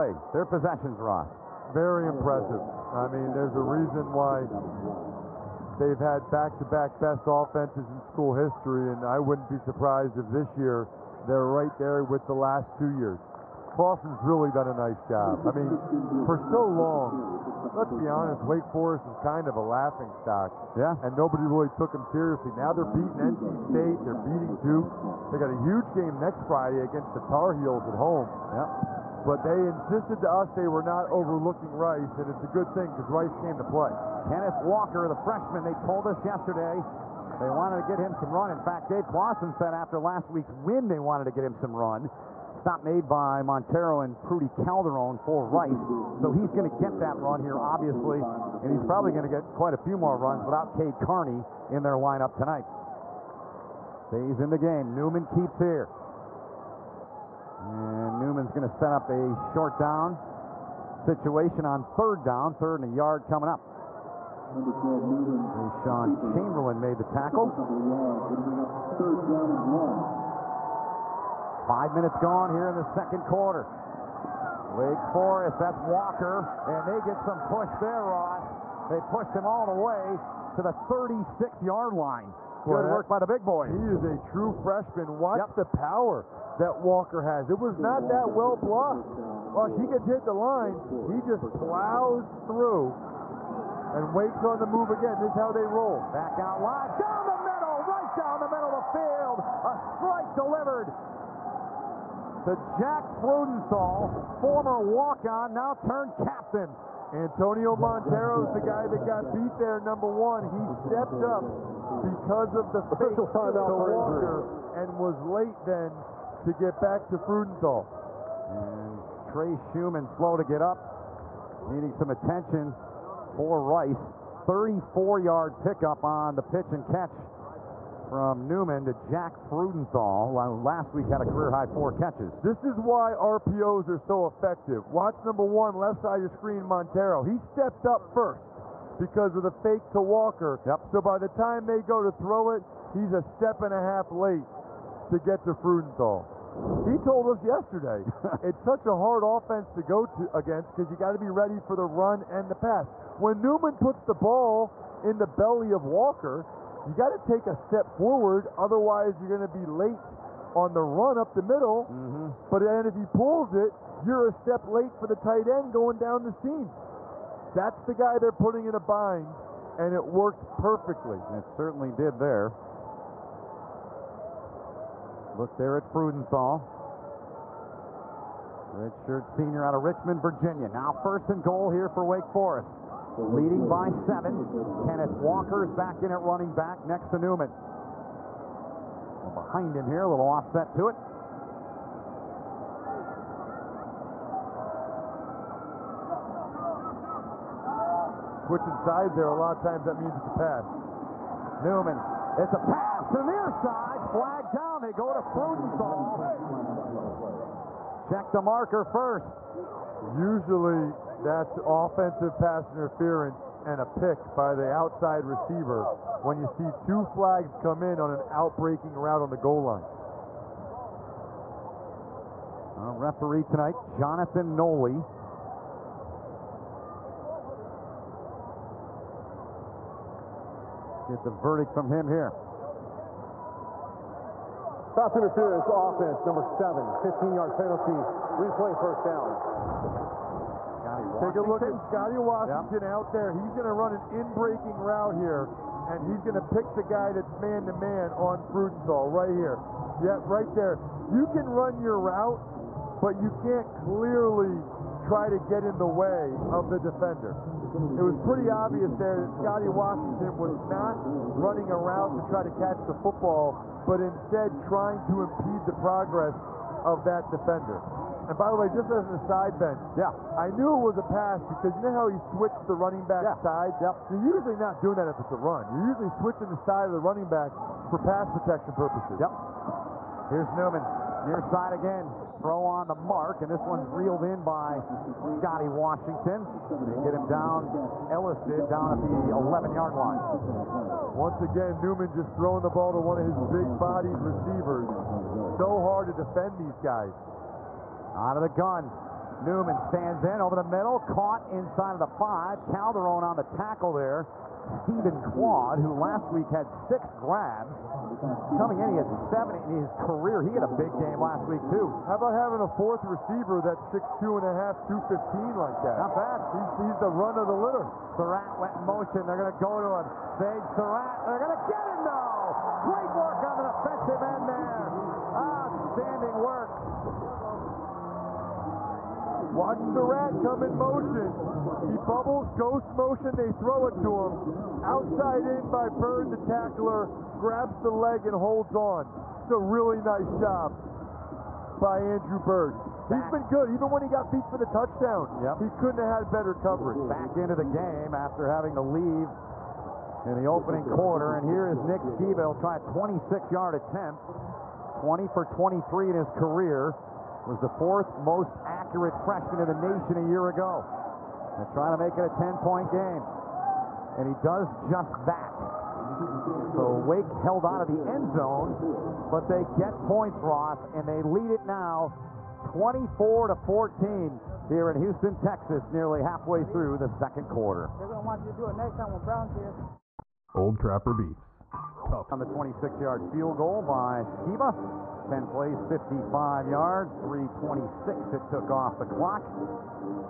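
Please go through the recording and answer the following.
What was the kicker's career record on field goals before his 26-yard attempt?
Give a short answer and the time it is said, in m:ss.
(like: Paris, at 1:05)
20 for 23, at 5:54.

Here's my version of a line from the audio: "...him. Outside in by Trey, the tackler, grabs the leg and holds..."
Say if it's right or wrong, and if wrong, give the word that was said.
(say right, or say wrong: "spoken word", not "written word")
wrong: "Bird", not "Trey".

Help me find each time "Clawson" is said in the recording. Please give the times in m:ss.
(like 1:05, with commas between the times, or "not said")
0:13, 0:39.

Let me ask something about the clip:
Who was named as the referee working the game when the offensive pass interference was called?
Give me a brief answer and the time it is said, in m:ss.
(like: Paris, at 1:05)
Jonathan Noley, at 3:43.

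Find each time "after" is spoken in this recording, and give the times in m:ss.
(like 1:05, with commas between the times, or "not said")
0:39, 5:48.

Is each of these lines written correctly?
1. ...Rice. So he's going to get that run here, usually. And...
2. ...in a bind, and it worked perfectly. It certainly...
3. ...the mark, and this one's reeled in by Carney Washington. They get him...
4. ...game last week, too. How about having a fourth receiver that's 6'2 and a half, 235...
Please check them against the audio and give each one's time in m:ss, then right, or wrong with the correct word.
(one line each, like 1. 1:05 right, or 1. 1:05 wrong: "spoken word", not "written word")
1. 0:45 wrong: "obviously", not "usually"
2. 2:48 right
3. 4:42 wrong: "Scotty", not "Carney"
4. 5:10 wrong: "215", not "235".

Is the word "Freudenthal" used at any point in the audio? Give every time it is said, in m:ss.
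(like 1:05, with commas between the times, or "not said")
1:43, 1:57, 2:09, 2:25, 2:55, 3:25, 4:08.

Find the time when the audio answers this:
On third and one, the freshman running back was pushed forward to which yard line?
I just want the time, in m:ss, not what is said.
1:20.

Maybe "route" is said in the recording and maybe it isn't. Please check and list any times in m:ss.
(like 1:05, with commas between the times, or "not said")
3:38, 4:04, 4:11.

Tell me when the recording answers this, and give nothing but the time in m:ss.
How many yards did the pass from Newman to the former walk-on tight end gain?
2:04.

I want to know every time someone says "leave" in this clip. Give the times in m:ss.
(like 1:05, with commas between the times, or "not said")
5:48.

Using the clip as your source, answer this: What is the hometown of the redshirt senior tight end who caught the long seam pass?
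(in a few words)
Richmond, Virginia.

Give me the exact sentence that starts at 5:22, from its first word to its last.
Great work on the defensive end there.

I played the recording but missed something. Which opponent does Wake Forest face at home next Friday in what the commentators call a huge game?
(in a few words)
Tar Heels.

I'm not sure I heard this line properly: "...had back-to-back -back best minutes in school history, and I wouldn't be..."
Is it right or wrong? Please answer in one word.
wrong.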